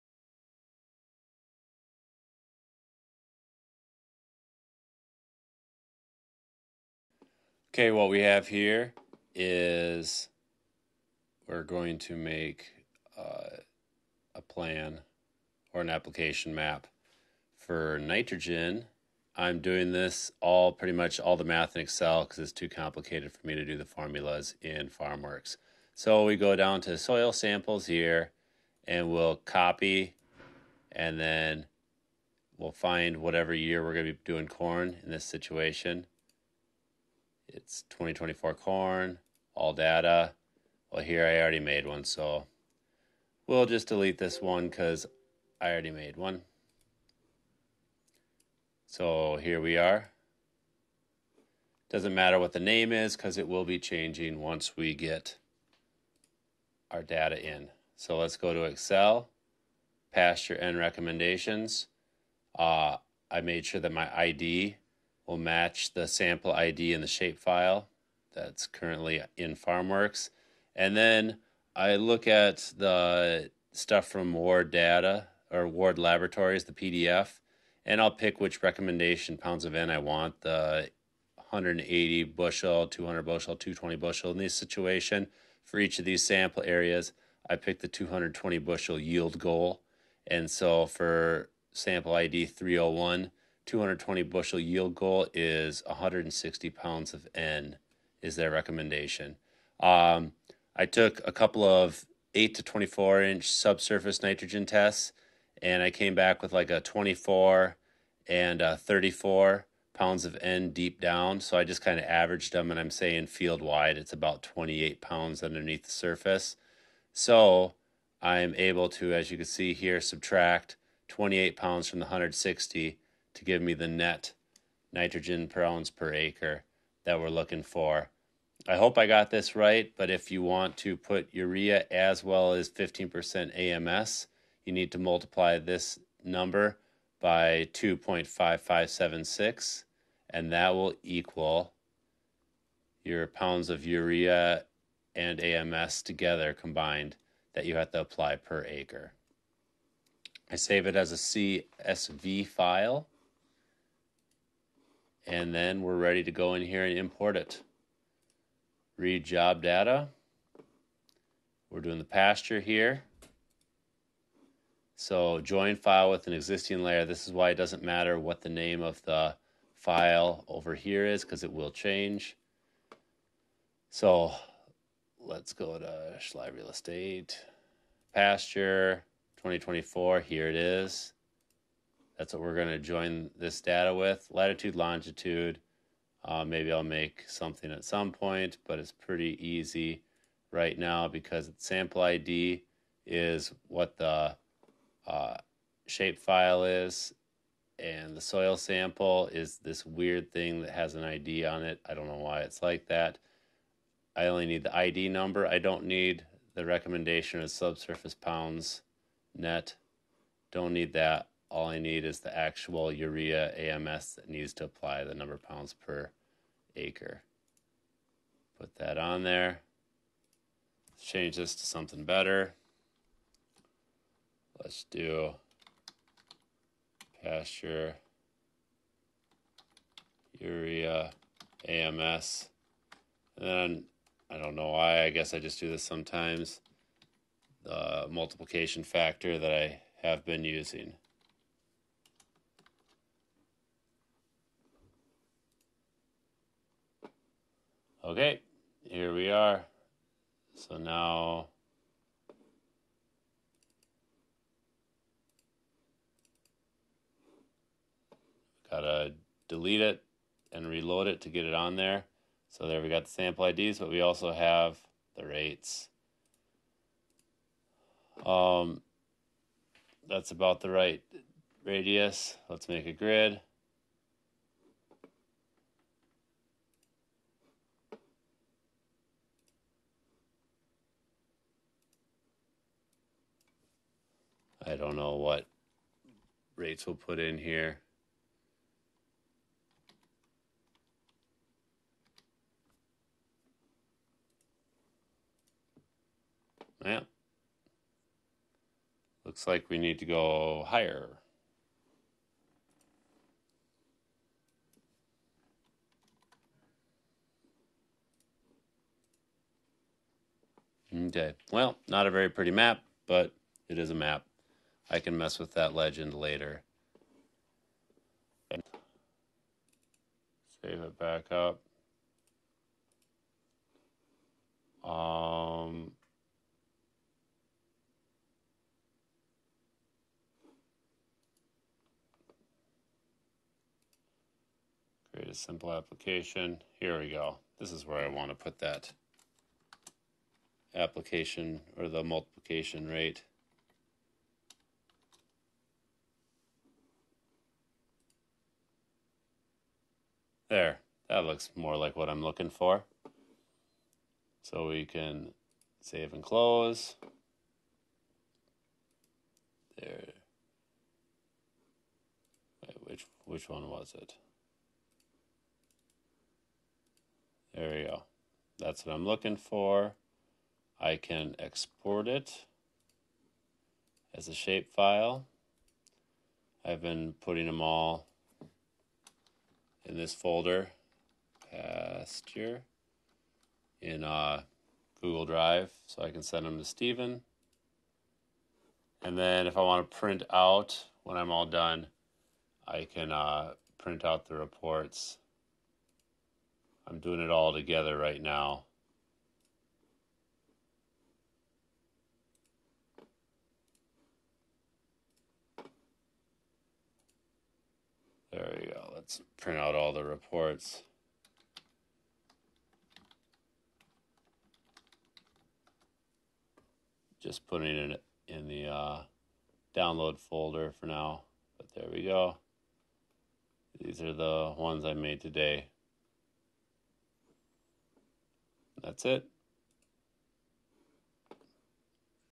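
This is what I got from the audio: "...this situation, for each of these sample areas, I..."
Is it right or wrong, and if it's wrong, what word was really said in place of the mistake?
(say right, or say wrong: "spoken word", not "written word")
right.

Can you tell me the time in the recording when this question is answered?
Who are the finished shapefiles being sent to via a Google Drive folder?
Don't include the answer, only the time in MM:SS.
06:26.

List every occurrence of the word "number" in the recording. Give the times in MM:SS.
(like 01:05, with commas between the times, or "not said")
02:16, 03:25, 03:35.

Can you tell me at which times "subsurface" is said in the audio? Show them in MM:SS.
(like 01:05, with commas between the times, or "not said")
01:43, 03:27.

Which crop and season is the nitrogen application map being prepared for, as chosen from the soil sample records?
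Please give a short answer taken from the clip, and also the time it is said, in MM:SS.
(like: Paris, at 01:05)
2024 corn, at 00:37.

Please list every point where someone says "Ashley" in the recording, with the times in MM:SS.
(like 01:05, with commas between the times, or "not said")
not said.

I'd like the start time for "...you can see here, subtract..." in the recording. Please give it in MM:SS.
01:59.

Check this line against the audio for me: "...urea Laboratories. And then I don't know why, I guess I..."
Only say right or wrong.
wrong.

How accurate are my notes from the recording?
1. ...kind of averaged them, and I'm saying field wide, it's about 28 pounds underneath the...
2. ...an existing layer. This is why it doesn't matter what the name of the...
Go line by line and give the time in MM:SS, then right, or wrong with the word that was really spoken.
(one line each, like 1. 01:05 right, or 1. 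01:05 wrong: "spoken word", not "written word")
1. 01:51 right
2. 02:46 right.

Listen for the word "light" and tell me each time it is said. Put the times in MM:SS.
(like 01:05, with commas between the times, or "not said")
not said.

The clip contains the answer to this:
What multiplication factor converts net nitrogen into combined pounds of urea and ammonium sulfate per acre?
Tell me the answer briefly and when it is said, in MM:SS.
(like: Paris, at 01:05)
2.5576, at 02:17.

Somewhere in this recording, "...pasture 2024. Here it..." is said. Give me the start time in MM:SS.
02:58.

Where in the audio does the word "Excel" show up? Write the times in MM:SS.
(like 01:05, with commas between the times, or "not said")
00:21, 00:58.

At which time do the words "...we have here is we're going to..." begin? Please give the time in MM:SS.
00:08.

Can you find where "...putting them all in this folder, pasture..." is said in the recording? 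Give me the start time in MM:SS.
06:17.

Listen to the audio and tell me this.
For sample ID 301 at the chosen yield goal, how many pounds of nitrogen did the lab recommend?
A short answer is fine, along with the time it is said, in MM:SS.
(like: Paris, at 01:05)
160, at 01:35.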